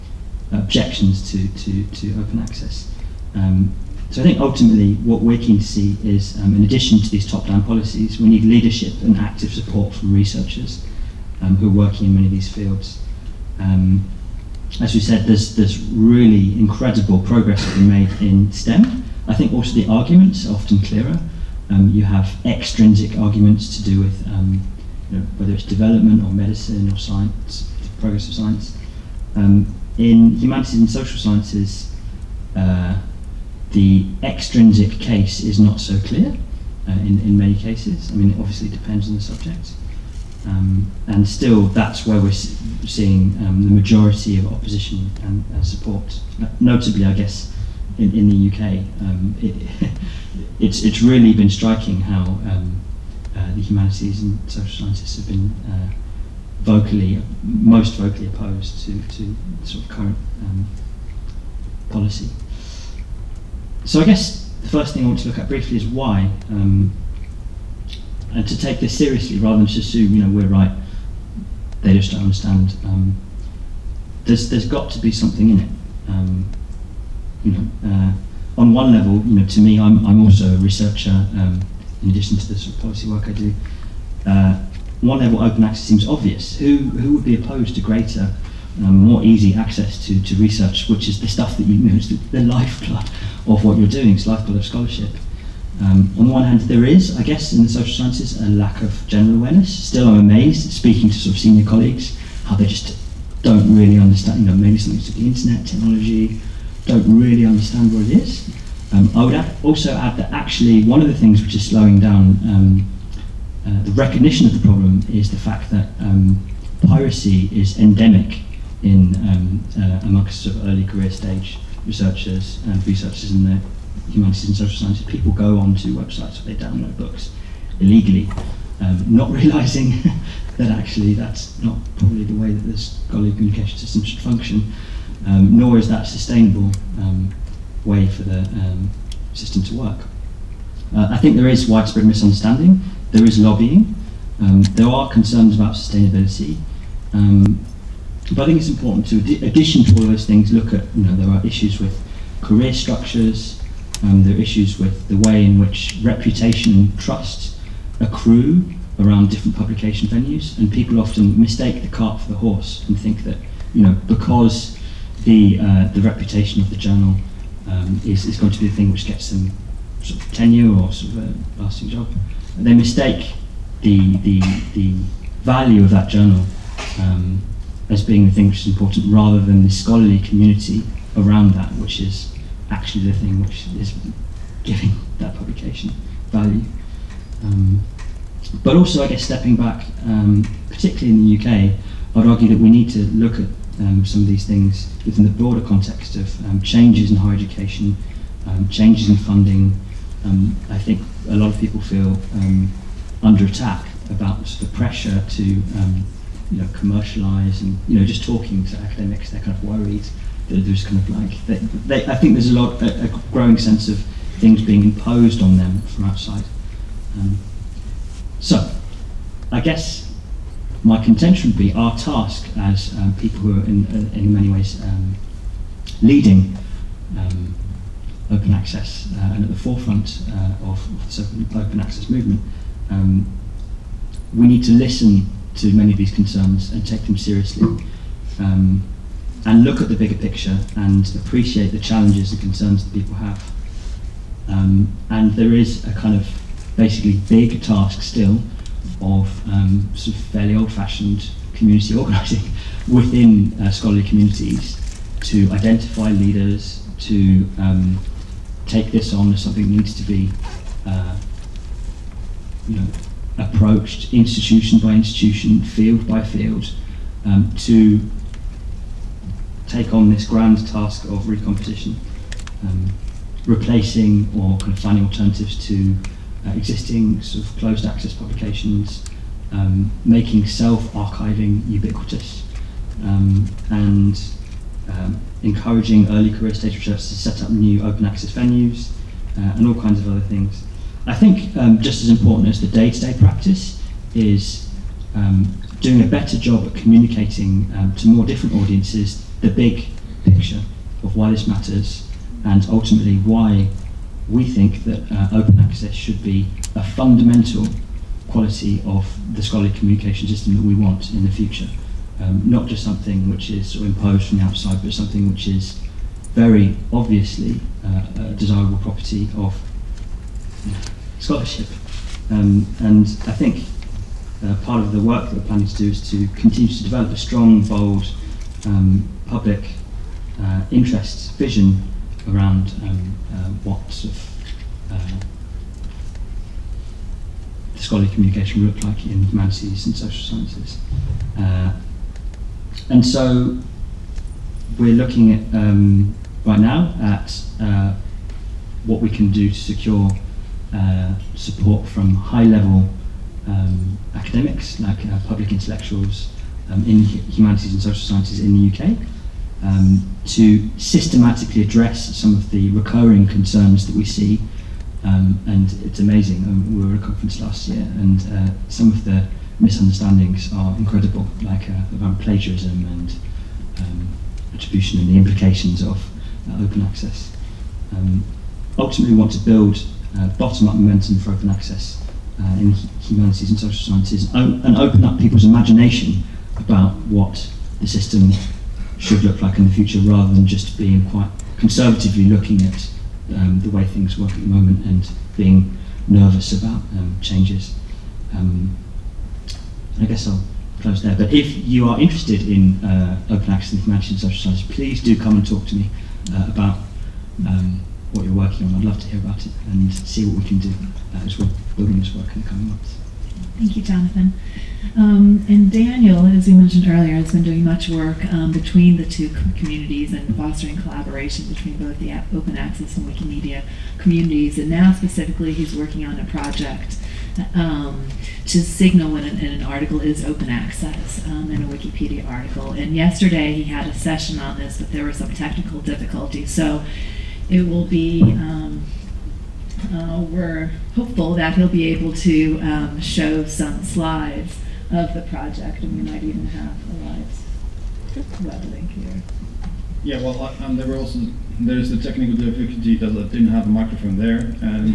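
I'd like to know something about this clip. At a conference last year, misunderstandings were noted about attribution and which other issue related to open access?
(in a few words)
Plagiarism.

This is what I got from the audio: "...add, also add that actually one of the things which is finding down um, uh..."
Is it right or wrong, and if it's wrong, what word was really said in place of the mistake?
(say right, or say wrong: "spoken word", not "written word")
wrong: "slowing", not "finding".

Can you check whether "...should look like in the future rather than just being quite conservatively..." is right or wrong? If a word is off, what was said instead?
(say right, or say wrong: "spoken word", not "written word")
right.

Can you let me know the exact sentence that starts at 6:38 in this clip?
Um, I guess I'll close there.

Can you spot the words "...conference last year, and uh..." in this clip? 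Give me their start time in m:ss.
6:07.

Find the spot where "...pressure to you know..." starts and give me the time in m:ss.
3:24.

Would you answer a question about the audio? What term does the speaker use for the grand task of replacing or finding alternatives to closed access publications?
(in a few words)
Recomposition.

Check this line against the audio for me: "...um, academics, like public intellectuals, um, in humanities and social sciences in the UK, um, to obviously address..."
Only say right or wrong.
wrong.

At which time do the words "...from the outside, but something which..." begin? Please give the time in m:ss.
5:14.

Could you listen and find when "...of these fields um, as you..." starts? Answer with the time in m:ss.
0:12.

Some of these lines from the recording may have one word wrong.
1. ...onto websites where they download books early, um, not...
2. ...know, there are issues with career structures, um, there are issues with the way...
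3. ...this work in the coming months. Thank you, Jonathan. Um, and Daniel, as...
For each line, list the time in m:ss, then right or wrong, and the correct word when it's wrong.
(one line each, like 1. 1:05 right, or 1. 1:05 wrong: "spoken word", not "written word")
1. 2:05 wrong: "illegally", not "early"
2. 2:31 right
3. 6:51 right.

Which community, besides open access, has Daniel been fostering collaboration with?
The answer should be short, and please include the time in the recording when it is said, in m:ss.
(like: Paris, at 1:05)
Wikimedia, at 7:03.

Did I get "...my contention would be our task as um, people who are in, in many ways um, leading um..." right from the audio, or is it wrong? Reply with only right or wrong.
right.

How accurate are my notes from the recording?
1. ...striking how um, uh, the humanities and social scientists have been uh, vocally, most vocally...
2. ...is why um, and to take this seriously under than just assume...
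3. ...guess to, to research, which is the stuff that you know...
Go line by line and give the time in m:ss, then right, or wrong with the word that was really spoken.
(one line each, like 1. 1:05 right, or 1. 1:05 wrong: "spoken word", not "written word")
1. 0:51 right
2. 1:05 wrong: "rather", not "under"
3. 1:29 wrong: "access", not "guess".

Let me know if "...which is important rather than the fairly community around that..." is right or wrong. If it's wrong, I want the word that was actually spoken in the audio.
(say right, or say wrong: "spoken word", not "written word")
wrong: "scholarly", not "fairly".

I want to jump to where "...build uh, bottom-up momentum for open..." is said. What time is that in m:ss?
6:19.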